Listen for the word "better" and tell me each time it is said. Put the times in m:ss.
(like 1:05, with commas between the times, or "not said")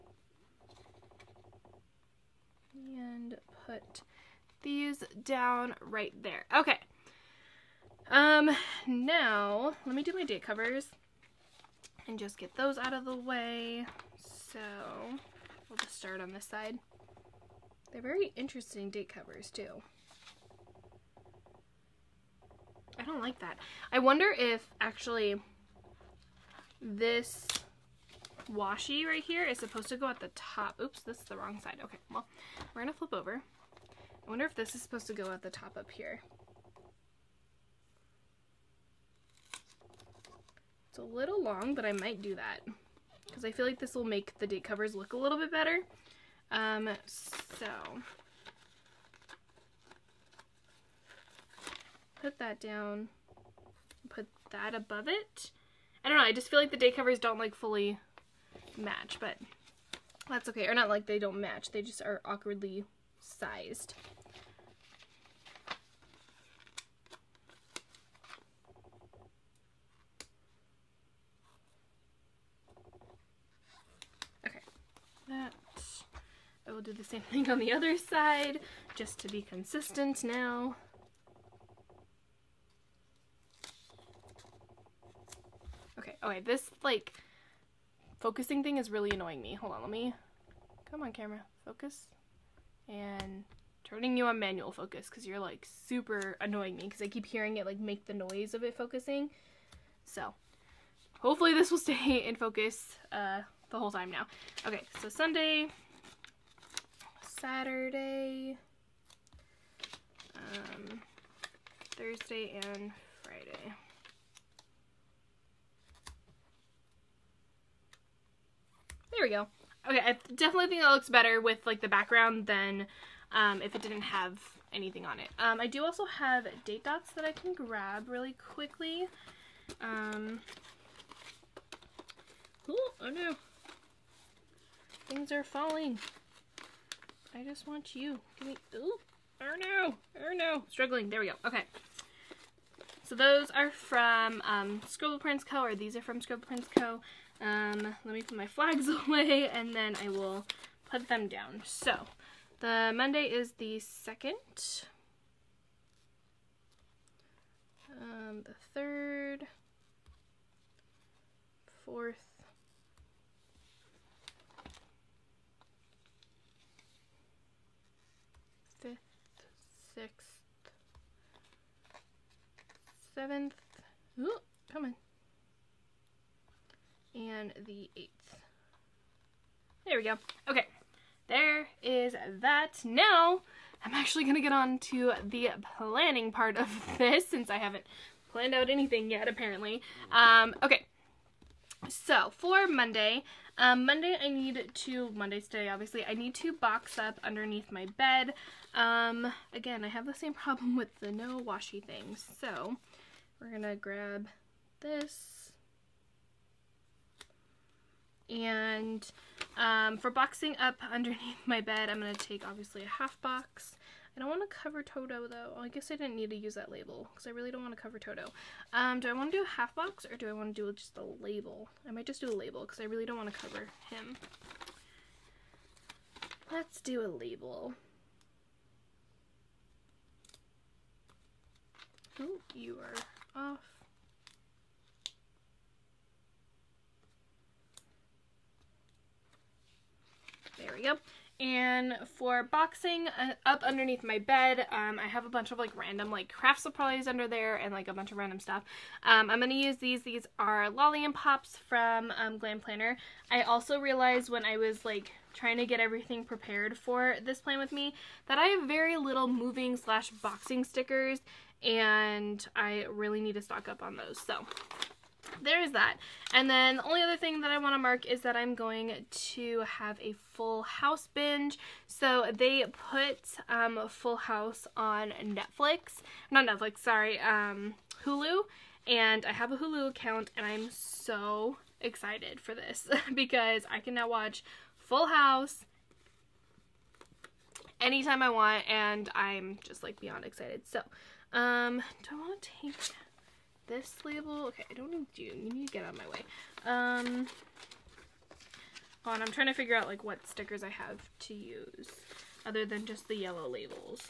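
0:45, 2:01.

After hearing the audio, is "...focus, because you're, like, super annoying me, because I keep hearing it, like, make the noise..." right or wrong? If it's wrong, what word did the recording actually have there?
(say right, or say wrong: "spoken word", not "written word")
right.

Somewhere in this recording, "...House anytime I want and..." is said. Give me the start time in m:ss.
4:45.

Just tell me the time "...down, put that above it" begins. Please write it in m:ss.
0:52.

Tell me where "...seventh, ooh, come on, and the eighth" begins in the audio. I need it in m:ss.
2:53.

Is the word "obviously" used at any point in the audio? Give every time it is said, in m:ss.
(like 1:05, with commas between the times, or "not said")
3:15, 3:32.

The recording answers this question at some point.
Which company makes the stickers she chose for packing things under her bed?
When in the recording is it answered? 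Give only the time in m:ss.
4:12.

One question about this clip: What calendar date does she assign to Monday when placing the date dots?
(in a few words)
2.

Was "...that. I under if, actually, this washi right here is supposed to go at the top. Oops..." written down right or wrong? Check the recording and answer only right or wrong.
wrong.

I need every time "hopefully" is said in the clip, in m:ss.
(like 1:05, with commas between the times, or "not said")
1:41.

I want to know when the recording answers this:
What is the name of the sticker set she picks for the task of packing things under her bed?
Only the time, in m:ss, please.
4:10.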